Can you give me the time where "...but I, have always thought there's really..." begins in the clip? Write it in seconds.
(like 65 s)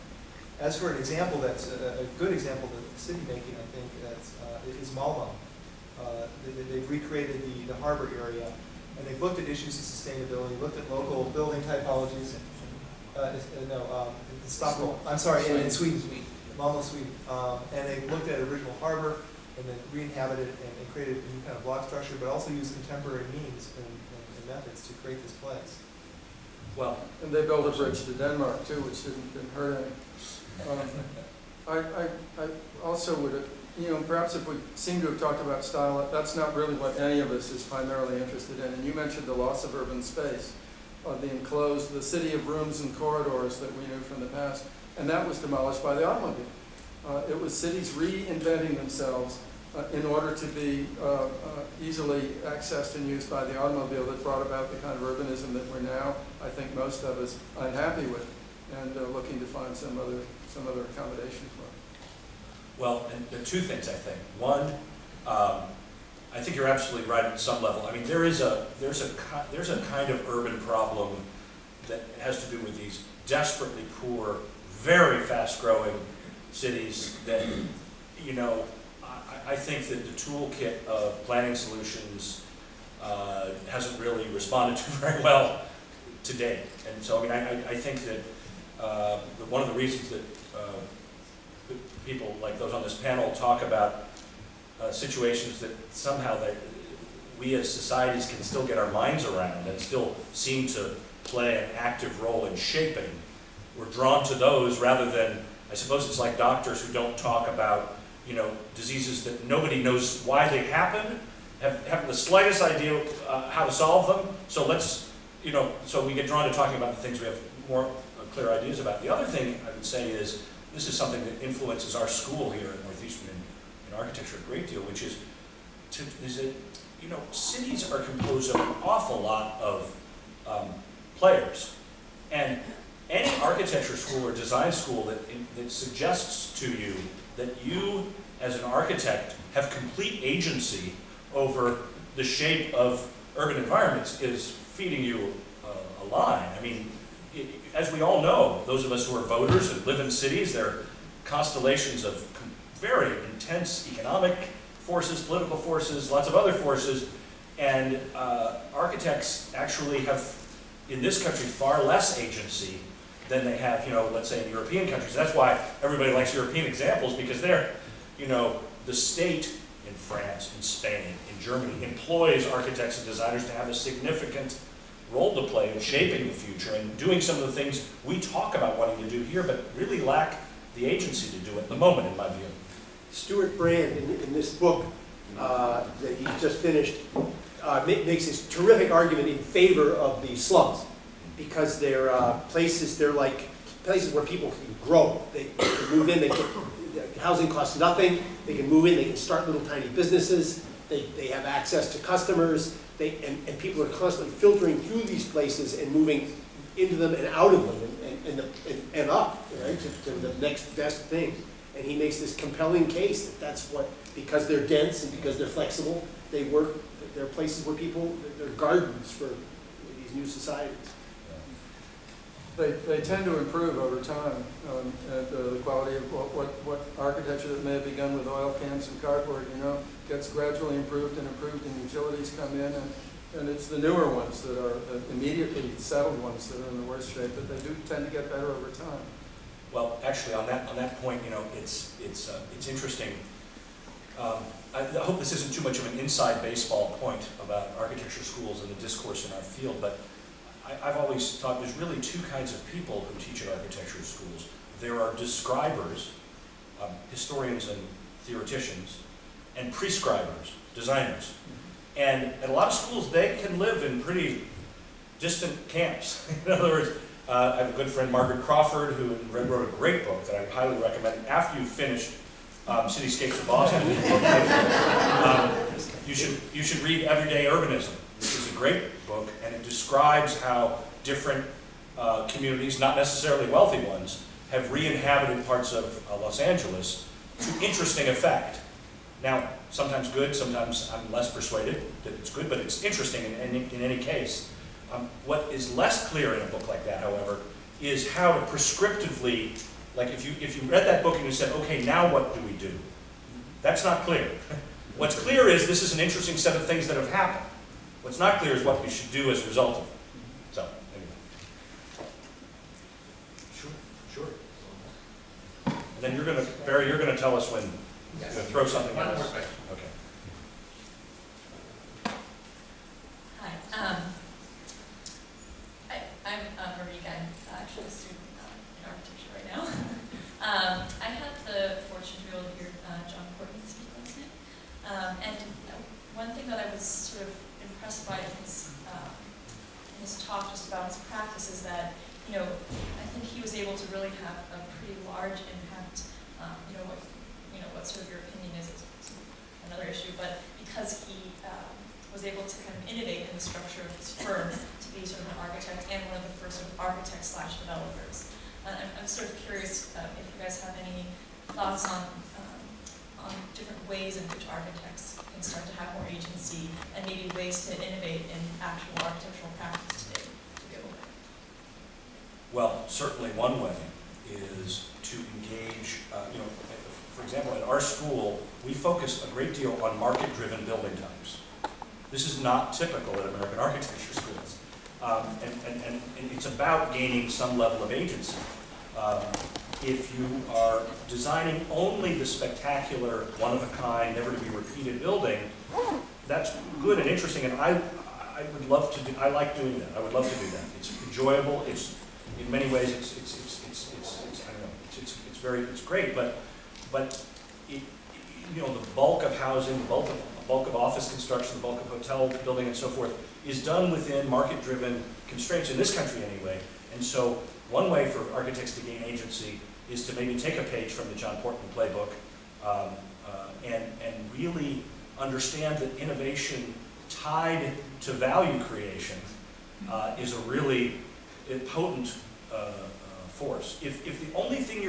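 249 s.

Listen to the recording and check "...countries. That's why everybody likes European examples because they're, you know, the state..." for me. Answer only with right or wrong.
right.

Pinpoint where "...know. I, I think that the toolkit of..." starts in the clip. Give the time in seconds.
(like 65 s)
78 s.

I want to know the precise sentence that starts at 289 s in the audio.
Now, sometimes good, sometimes I'm less persuaded that it's good, but it's interesting in, in, in any case.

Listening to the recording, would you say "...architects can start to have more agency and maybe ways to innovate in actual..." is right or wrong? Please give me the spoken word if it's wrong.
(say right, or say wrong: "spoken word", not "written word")
right.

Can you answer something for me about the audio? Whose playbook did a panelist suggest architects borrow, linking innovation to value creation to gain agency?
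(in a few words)
John Portman.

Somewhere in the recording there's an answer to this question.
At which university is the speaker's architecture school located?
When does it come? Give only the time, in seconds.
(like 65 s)
122 s.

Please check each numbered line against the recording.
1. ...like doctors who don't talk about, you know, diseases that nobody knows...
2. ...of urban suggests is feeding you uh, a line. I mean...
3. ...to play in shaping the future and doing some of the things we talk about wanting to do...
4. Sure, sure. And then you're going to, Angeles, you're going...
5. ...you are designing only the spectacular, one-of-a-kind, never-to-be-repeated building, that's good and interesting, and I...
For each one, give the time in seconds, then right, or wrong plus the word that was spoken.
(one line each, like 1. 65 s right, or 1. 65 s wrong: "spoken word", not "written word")
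1. 106 s right
2. 142 s wrong: "environments", not "suggests"
3. 175 s right
4. 313 s wrong: "Barry", not "Angeles"
5. 390 s right.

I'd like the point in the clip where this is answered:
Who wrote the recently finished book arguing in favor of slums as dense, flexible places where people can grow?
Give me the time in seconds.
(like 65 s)
183 s.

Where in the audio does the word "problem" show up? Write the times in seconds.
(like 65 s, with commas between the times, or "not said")
70 s.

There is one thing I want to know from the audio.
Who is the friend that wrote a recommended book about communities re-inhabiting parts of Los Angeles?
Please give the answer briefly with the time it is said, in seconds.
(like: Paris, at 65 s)
Margaret Crawford, at 268 s.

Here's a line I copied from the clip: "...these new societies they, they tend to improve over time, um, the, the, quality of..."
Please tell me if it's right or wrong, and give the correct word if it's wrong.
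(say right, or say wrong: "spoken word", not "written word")
right.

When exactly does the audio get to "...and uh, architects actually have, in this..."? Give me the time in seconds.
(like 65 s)
157 s.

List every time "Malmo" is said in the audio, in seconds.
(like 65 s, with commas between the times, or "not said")
4 s, 16 s.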